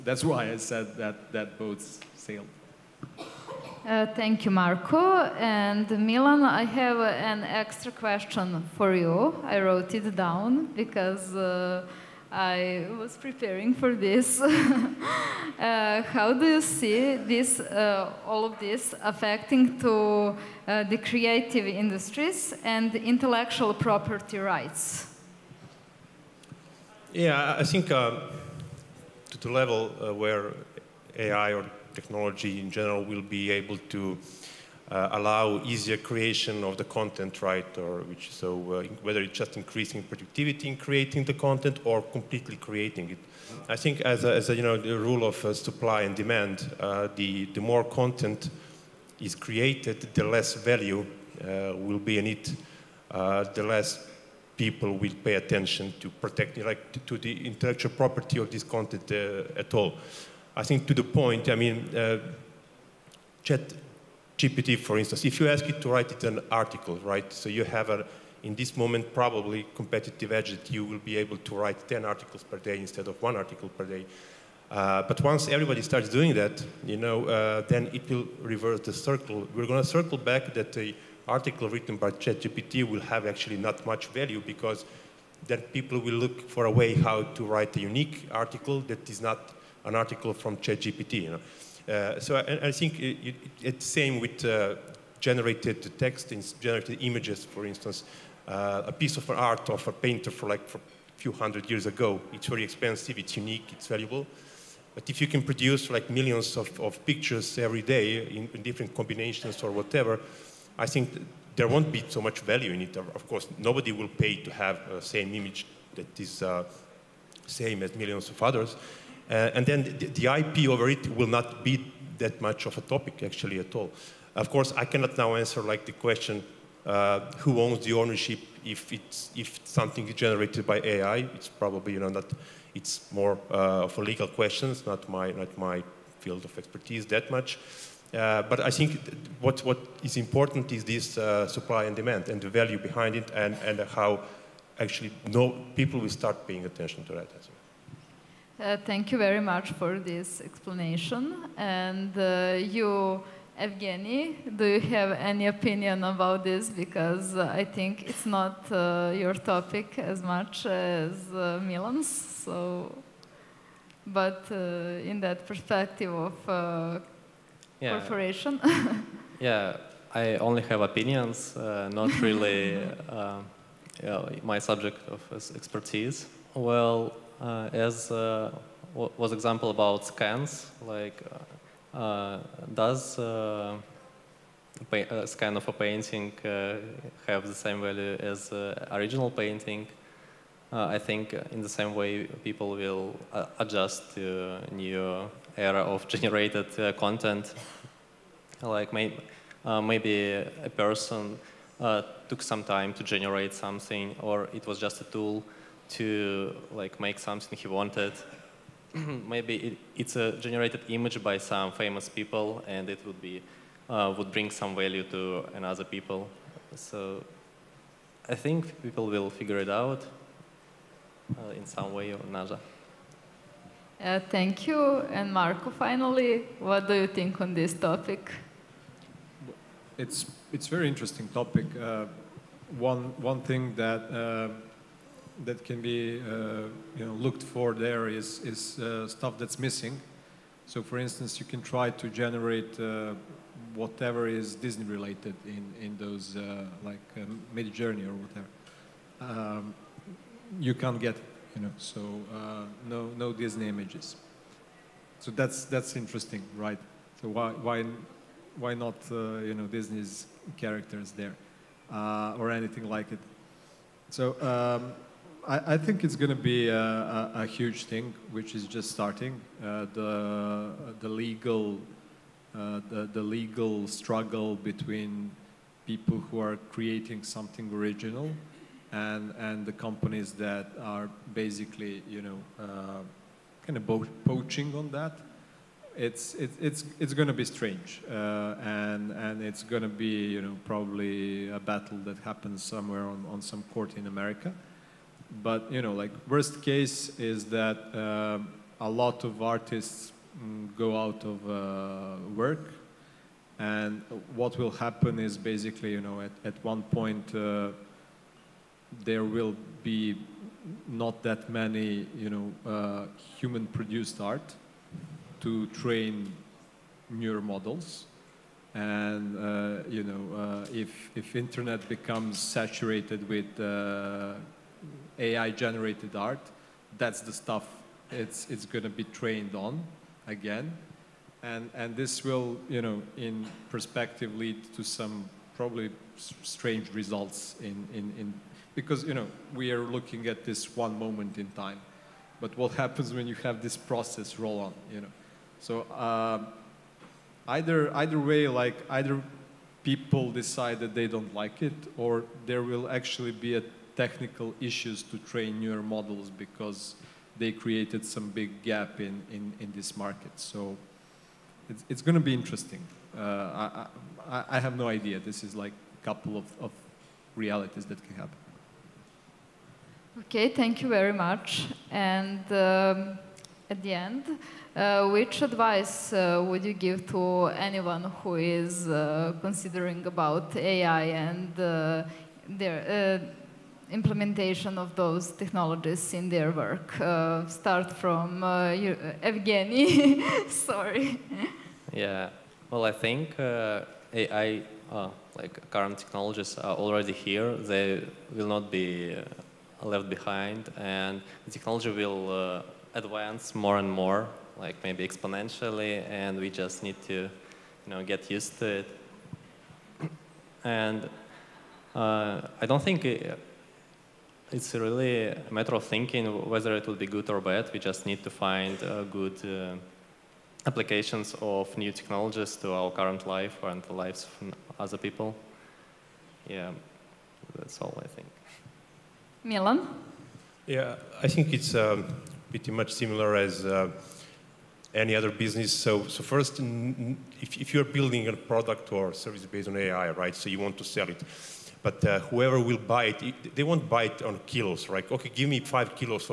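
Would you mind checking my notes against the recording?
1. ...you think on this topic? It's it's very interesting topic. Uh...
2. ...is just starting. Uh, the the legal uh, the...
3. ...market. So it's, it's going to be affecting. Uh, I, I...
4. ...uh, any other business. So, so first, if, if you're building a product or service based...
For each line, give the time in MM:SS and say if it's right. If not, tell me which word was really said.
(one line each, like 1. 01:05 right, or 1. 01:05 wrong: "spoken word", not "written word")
1. 03:46 right
2. 04:28 right
3. 05:59 wrong: "interesting", not "affecting"
4. 07:13 right.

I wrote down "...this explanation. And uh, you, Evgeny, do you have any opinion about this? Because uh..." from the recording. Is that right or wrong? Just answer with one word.
right.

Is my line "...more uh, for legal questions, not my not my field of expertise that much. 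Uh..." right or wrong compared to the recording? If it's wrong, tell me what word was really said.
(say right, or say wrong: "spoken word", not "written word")
right.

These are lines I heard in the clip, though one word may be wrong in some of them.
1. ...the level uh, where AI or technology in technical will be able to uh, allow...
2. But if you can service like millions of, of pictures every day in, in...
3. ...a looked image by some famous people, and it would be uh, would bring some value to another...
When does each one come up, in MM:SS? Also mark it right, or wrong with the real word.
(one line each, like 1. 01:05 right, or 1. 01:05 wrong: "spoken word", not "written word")
1. 00:29 wrong: "general", not "technical"
2. 01:44 wrong: "produce", not "service"
3. 03:30 wrong: "generated", not "looked".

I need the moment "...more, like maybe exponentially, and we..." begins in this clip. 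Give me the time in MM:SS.
06:43.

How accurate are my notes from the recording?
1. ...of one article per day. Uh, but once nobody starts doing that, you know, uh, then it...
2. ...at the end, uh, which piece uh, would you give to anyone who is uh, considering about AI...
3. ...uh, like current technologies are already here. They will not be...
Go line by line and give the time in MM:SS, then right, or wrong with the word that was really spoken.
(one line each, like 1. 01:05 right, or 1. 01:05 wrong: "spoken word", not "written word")
1. 01:13 wrong: "everybody", not "nobody"
2. 06:13 wrong: "advice", not "piece"
3. 06:34 right.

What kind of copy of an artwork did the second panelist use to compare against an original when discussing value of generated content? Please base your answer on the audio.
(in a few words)
a scan.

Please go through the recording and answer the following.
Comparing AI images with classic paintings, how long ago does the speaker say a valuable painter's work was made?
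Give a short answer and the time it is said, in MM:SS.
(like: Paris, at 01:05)
a few hundred, at 01:40.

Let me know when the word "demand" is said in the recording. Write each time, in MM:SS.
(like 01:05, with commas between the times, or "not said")
00:46, 02:21.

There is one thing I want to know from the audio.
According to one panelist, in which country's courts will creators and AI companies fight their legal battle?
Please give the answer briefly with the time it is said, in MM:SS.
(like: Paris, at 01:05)
America, at 04:54.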